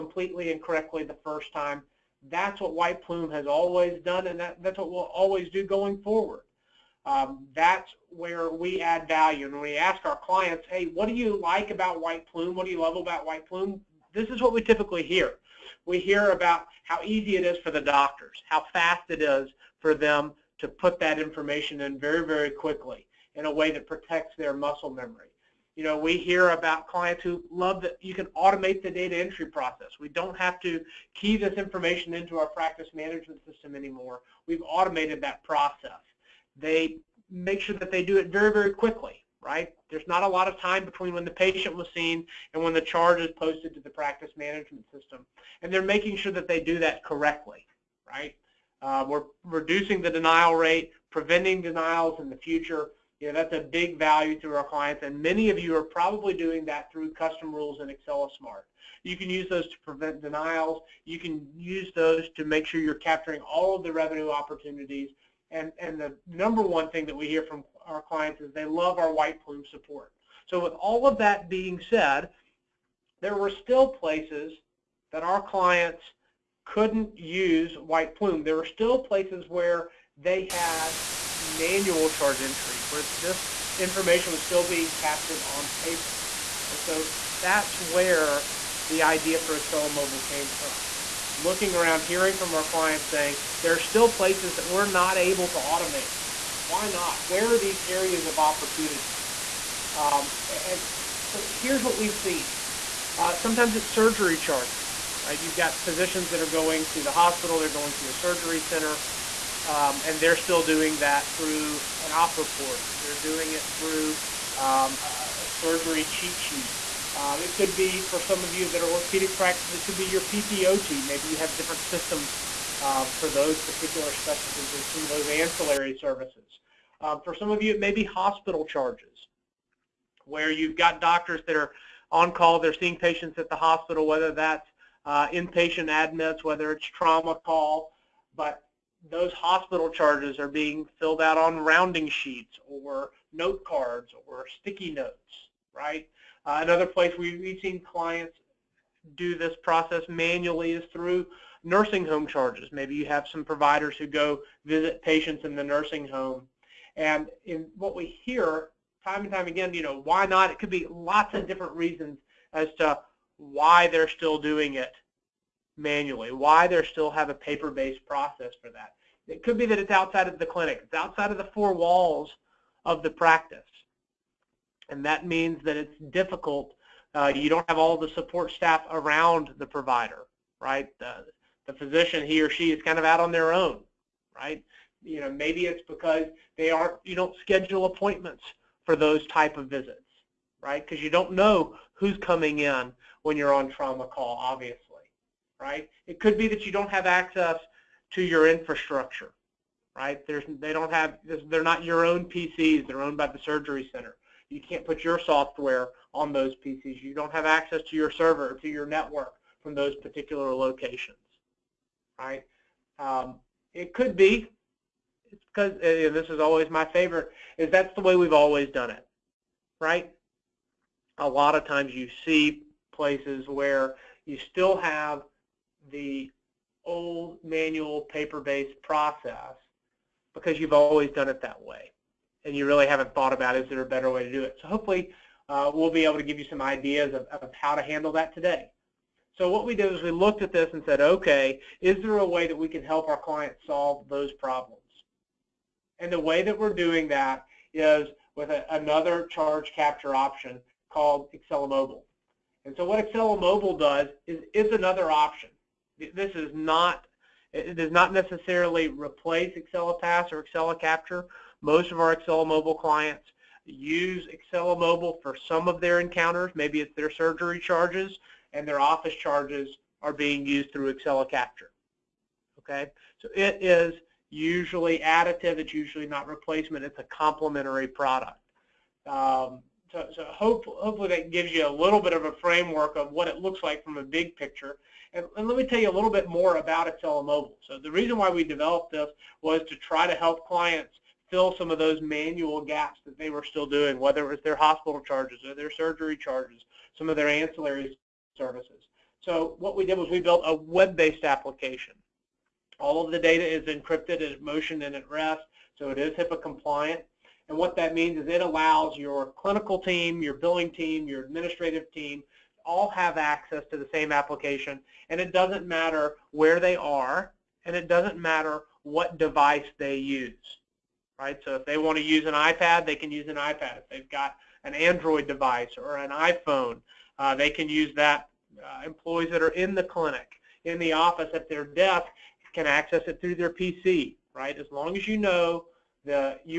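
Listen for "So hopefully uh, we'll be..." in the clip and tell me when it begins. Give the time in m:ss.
3:54.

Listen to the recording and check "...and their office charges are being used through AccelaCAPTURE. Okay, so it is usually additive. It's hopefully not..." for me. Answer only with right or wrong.
wrong.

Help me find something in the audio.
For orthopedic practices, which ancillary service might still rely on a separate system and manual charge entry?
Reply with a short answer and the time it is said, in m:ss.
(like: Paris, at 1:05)
PTOT, at 2:00.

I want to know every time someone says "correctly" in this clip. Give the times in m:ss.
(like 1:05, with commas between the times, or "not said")
0:00, 0:47.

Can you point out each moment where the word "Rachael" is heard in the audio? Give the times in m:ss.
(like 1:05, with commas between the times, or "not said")
not said.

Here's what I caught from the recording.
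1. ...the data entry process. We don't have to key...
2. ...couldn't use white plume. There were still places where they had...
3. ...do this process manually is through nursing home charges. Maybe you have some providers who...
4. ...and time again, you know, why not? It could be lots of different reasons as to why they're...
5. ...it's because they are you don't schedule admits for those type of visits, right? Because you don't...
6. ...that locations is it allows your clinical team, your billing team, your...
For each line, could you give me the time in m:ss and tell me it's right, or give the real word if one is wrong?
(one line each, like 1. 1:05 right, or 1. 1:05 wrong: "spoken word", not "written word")
1. 0:28 right
2. 1:16 right
3. 2:29 right
4. 2:39 right
5. 3:05 wrong: "appointments", not "admits"
6. 5:07 wrong: "means", not "locations".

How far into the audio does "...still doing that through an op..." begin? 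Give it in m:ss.
1:50.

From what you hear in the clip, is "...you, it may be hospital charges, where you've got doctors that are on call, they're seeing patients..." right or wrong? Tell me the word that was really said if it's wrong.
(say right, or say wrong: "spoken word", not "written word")
right.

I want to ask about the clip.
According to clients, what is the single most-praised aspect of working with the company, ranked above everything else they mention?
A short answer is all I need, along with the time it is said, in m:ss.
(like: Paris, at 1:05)
White Plume support, at 1:09.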